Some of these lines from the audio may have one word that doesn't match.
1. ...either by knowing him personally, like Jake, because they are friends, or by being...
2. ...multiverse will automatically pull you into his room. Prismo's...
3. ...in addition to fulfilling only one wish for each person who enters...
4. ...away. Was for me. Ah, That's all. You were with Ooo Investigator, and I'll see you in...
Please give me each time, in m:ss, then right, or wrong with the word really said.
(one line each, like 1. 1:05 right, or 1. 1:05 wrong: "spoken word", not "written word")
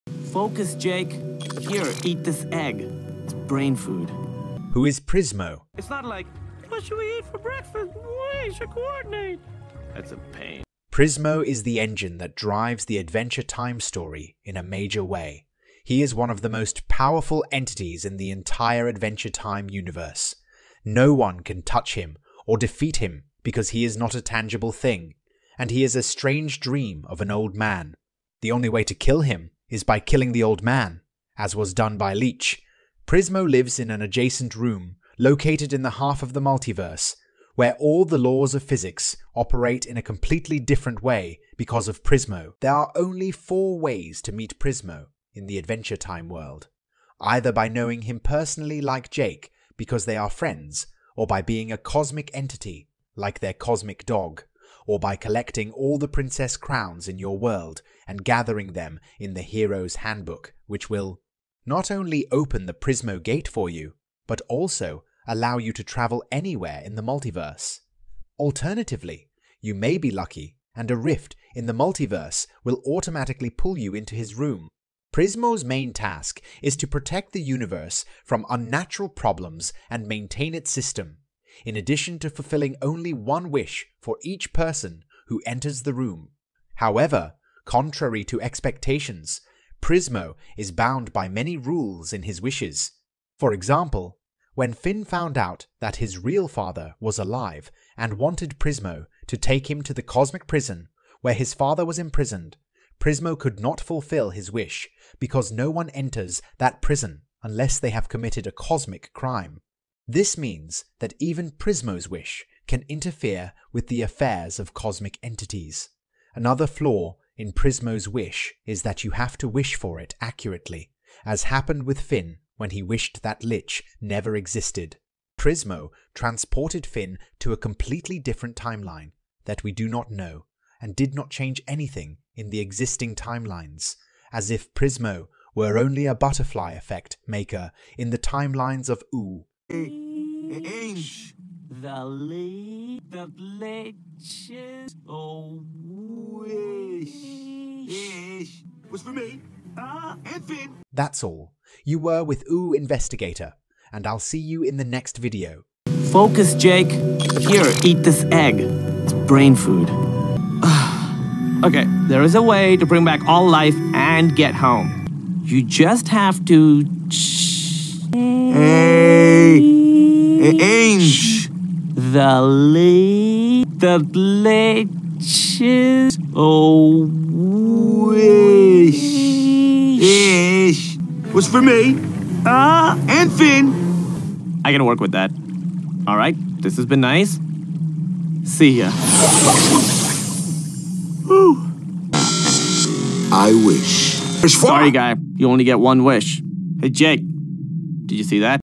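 1. 0:47 right
2. 1:11 right
3. 1:21 right
4. 2:25 right.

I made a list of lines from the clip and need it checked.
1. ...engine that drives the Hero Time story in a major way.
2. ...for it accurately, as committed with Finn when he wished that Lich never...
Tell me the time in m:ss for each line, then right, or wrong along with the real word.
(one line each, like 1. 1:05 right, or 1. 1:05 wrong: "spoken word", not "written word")
1. 0:11 wrong: "Adventure", not "Hero"
2. 1:59 wrong: "happened", not "committed".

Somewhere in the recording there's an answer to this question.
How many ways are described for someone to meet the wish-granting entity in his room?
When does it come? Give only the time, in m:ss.
0:43.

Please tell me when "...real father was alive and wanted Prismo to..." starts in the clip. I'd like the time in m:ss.
1:36.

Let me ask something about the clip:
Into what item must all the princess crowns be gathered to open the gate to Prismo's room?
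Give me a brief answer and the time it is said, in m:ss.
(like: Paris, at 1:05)
Hero's Handbook, at 0:59.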